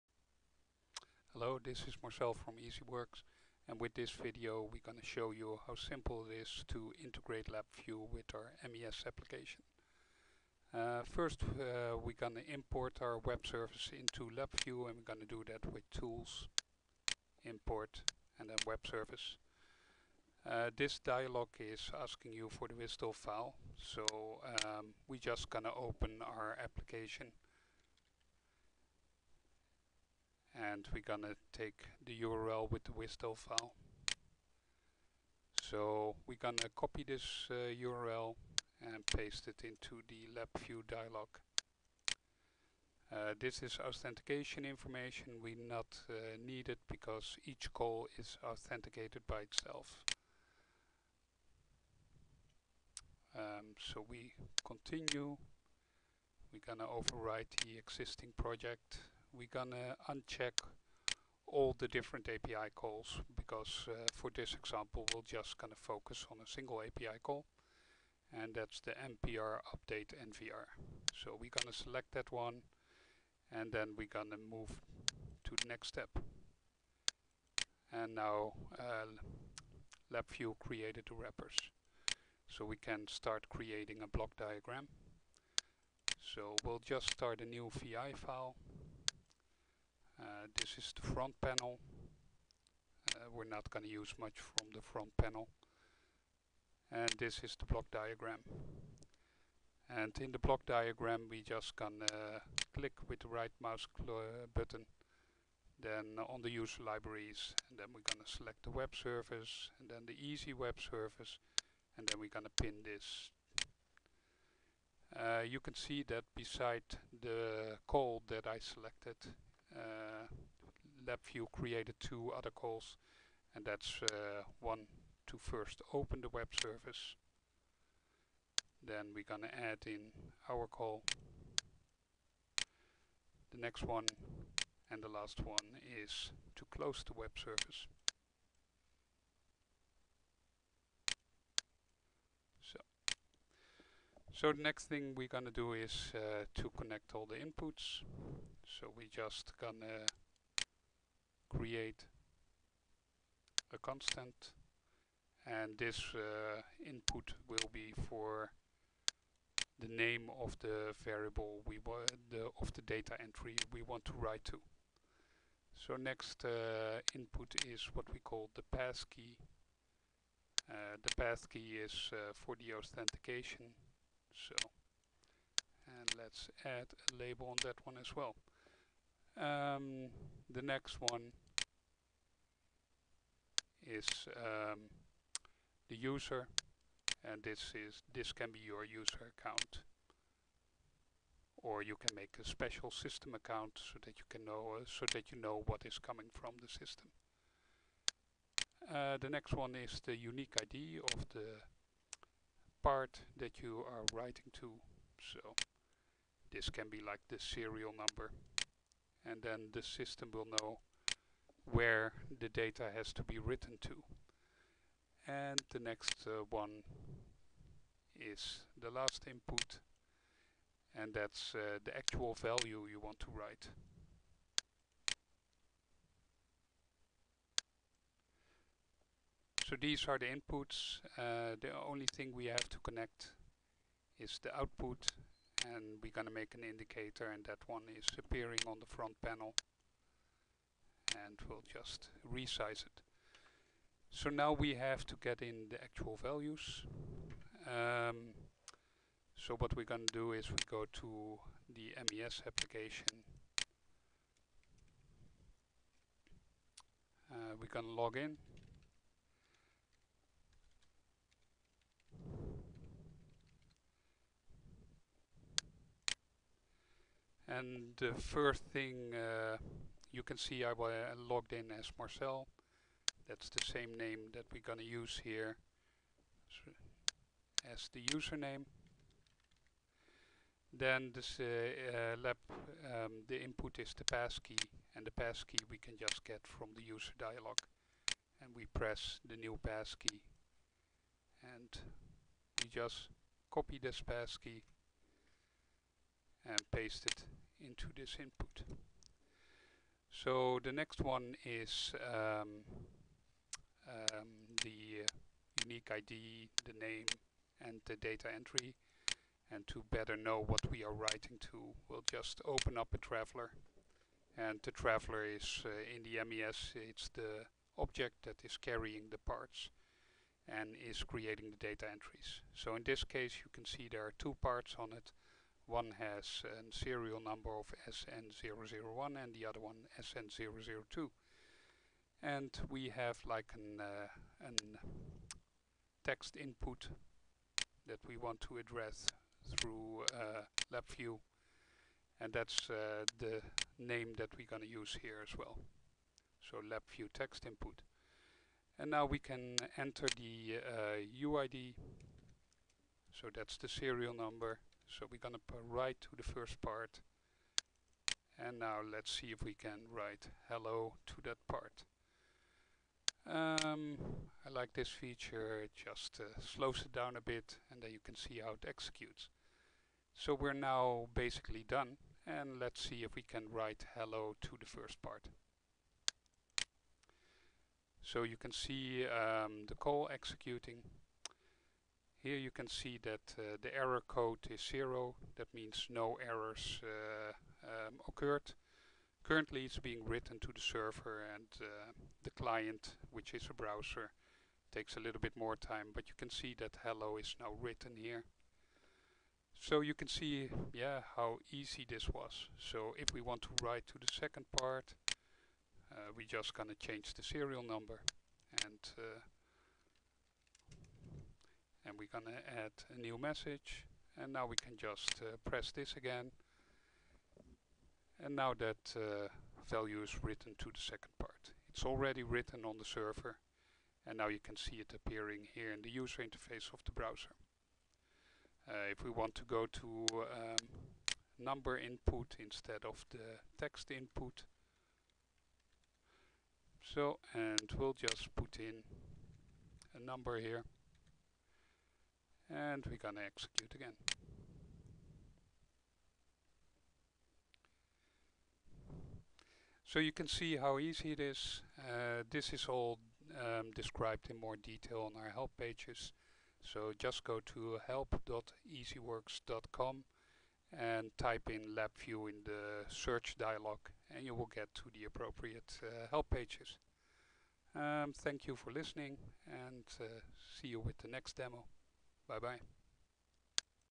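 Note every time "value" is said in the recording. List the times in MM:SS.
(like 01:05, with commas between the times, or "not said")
03:42, 04:06, 06:59.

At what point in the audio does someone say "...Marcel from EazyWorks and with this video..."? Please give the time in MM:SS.
00:02.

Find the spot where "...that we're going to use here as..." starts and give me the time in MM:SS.
05:44.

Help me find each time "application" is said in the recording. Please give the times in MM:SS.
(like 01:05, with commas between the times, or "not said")
00:09, 00:26, 04:12.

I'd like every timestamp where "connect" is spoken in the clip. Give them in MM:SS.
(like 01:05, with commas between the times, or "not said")
02:26, 03:52.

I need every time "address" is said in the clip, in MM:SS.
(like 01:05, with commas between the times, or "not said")
05:38.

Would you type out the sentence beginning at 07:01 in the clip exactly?
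It's already written on the server and now you can see it appearing here in the user interface of the browser.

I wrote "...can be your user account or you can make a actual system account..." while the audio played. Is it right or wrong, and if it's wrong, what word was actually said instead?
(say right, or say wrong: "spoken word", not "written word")
wrong: "special", not "actual".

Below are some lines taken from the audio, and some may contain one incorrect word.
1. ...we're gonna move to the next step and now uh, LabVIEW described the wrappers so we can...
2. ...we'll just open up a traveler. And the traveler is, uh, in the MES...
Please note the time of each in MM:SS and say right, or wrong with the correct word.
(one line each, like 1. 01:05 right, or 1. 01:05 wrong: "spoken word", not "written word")
1. 01:13 wrong: "created", not "described"
2. 05:11 right.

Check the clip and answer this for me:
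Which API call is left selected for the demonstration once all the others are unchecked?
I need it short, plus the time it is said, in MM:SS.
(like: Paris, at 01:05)
npr update nvr, at 01:08.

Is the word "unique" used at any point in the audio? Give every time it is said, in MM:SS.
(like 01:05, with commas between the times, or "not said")
03:20, 05:05.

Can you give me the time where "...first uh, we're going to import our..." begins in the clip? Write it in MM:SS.
00:11.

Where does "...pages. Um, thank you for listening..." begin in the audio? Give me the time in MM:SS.
07:46.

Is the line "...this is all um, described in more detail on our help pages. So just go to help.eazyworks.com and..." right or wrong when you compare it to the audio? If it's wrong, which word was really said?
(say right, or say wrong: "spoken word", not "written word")
right.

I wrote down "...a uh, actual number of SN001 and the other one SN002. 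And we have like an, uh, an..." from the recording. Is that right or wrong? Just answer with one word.
wrong.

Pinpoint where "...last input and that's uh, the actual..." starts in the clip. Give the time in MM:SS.
03:38.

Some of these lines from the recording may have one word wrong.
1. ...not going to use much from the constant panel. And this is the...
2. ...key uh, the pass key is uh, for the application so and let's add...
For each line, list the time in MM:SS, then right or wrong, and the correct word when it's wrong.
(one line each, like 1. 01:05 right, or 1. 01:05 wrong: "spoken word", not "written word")
1. 01:33 wrong: "front", not "constant"
2. 02:49 wrong: "authentication", not "application".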